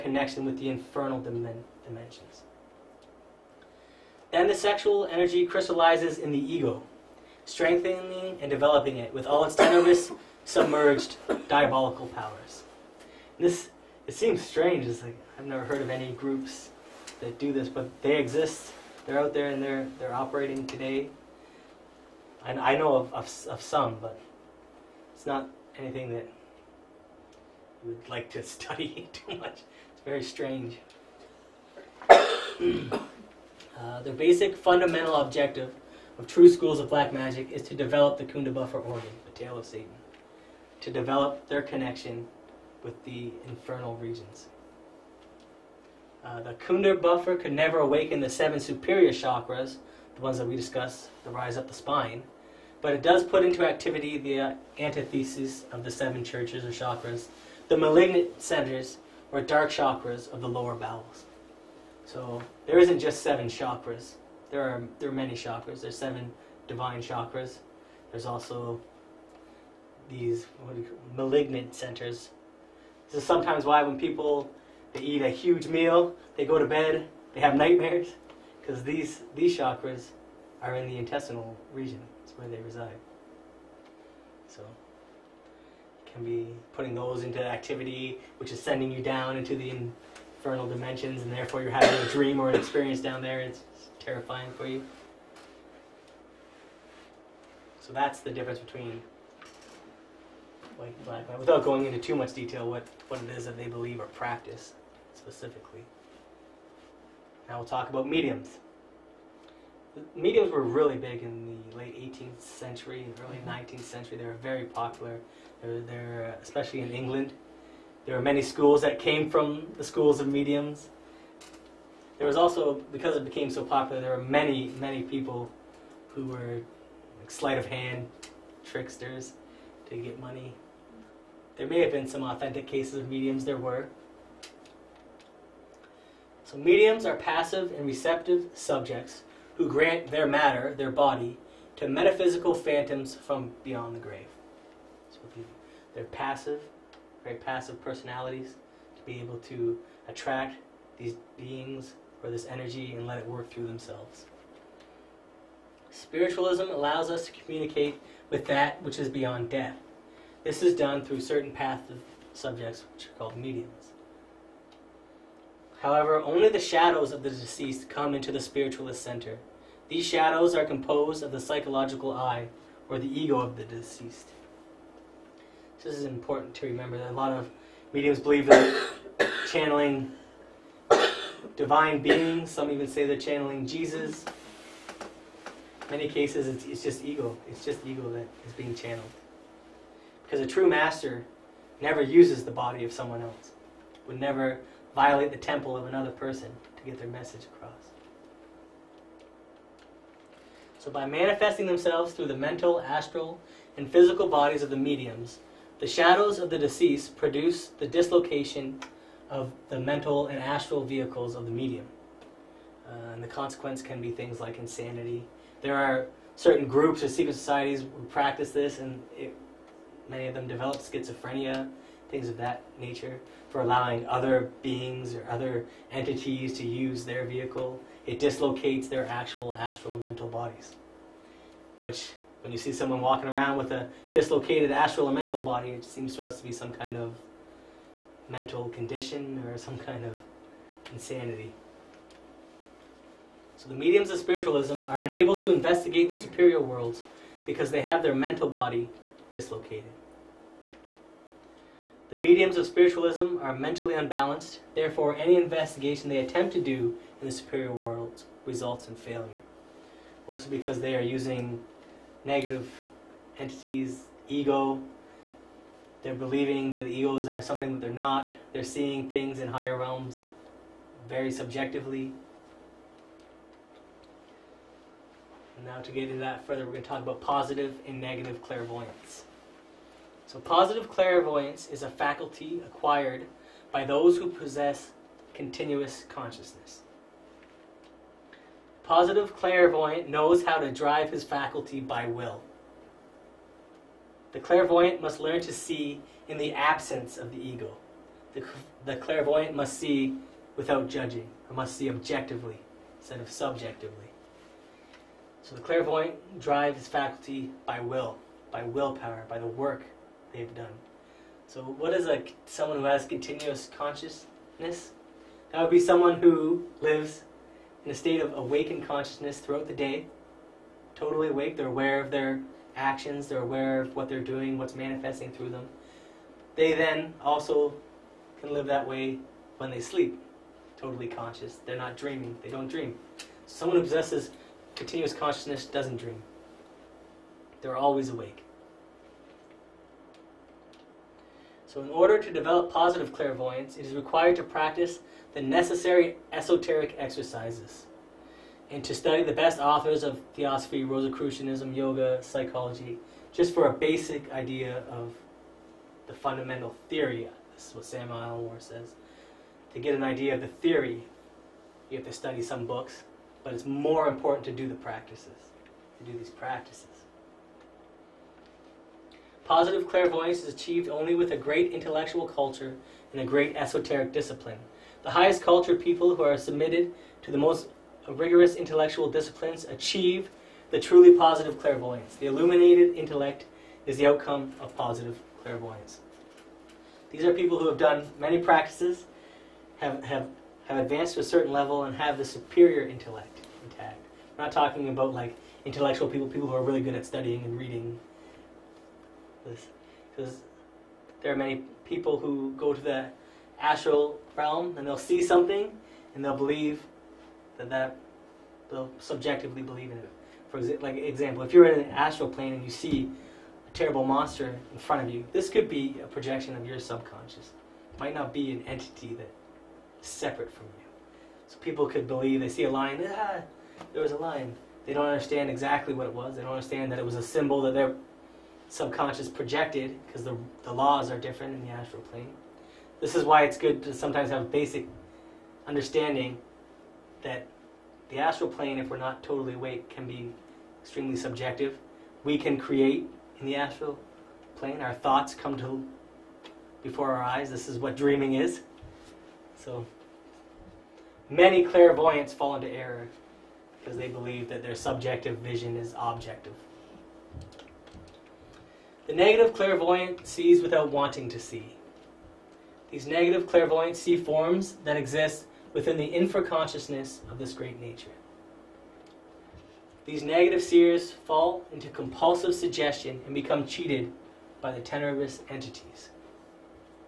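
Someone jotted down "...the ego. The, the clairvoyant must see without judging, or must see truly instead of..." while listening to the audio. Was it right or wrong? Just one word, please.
wrong.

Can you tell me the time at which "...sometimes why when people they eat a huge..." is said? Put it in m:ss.
1:13.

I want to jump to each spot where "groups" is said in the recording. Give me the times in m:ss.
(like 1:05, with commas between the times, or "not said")
0:16, 3:36.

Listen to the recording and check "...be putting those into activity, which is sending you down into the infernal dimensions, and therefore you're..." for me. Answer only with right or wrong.
right.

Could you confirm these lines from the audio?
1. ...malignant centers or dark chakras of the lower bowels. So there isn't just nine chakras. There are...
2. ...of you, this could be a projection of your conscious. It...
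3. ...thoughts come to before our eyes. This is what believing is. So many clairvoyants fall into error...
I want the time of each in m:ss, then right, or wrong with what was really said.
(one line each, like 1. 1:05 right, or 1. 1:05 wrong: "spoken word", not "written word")
1. 0:57 wrong: "seven", not "nine"
2. 6:55 wrong: "subconscious", not "conscious"
3. 7:24 wrong: "dreaming", not "believing".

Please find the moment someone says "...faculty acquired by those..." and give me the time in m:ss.
4:41.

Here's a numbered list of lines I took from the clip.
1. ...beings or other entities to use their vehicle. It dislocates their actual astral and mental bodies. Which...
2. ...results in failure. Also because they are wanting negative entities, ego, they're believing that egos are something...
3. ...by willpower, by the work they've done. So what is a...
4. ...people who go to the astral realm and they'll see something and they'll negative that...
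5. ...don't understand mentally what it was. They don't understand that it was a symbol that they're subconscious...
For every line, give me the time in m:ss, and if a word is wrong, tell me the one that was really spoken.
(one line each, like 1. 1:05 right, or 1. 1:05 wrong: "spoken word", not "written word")
1. 3:44 right
2. 4:18 wrong: "using", not "wanting"
3. 5:08 right
4. 6:41 wrong: "believe", not "negative"
5. 7:04 wrong: "exactly", not "mentally".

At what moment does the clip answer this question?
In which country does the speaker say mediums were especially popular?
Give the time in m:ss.
1:56.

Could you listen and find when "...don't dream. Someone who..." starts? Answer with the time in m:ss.
5:32.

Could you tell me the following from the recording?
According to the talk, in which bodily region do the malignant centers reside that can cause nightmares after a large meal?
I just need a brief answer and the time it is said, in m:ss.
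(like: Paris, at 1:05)
Intestinal region, at 1:20.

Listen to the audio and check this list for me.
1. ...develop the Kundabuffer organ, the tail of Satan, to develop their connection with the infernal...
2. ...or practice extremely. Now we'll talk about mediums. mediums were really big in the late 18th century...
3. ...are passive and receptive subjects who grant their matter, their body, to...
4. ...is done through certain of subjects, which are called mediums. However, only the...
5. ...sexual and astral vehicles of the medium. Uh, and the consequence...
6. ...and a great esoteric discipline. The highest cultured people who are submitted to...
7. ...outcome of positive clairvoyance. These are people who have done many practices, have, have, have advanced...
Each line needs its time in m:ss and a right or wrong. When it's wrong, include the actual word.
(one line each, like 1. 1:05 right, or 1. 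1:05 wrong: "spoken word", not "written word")
1. 0:37 right
2. 1:43 wrong: "specifically", not "extremely"
3. 2:17 right
4. 2:40 right
5. 3:29 wrong: "mental", not "sexual"
6. 6:13 right
7. 6:24 right.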